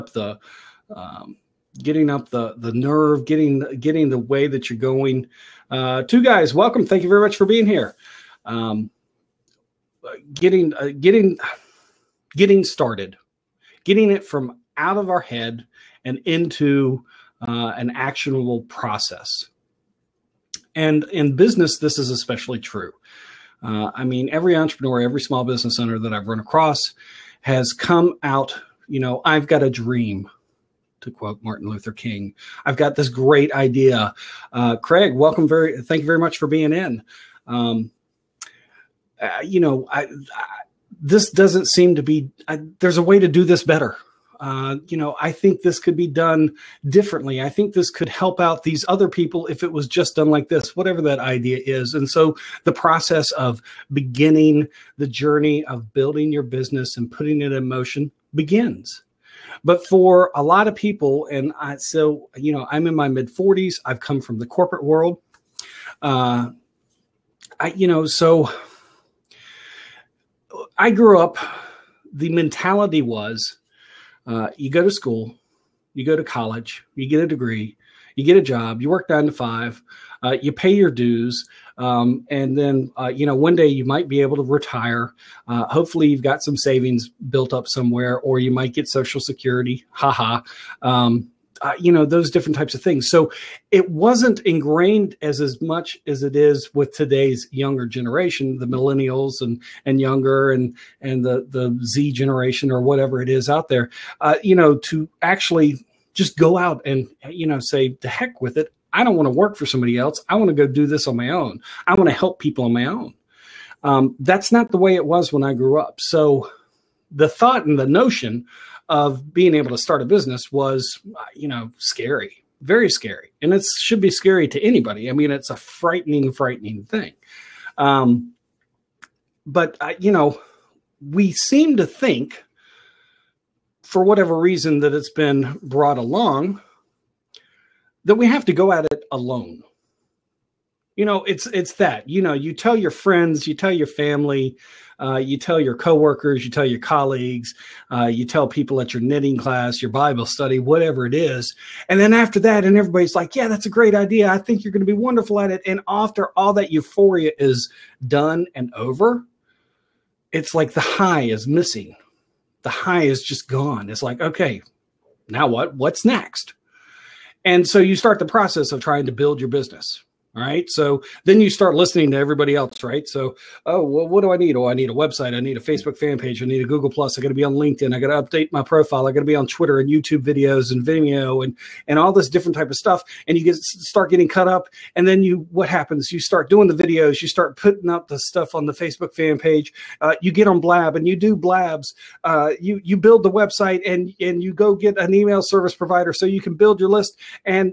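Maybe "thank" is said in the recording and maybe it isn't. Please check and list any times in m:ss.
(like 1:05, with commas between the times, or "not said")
0:06, 0:35.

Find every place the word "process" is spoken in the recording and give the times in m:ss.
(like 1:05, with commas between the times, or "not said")
0:18, 0:52, 2:48.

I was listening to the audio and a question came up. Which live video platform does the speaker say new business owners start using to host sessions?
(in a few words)
Blab.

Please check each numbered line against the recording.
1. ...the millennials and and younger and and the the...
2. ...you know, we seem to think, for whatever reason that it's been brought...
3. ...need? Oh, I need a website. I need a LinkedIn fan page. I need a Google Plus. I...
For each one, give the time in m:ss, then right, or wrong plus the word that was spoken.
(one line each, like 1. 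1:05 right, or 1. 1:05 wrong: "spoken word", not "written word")
1. 1:38 right
2. 2:09 right
3. 2:54 wrong: "Facebook", not "LinkedIn".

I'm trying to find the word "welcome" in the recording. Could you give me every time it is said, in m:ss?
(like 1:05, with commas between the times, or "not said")
0:06, 0:35.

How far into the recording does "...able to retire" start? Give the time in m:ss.
1:24.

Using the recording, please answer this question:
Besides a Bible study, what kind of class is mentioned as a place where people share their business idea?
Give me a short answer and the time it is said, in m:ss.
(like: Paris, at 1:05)
knitting class, at 2:29.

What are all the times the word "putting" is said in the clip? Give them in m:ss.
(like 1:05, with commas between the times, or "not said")
0:57, 3:07.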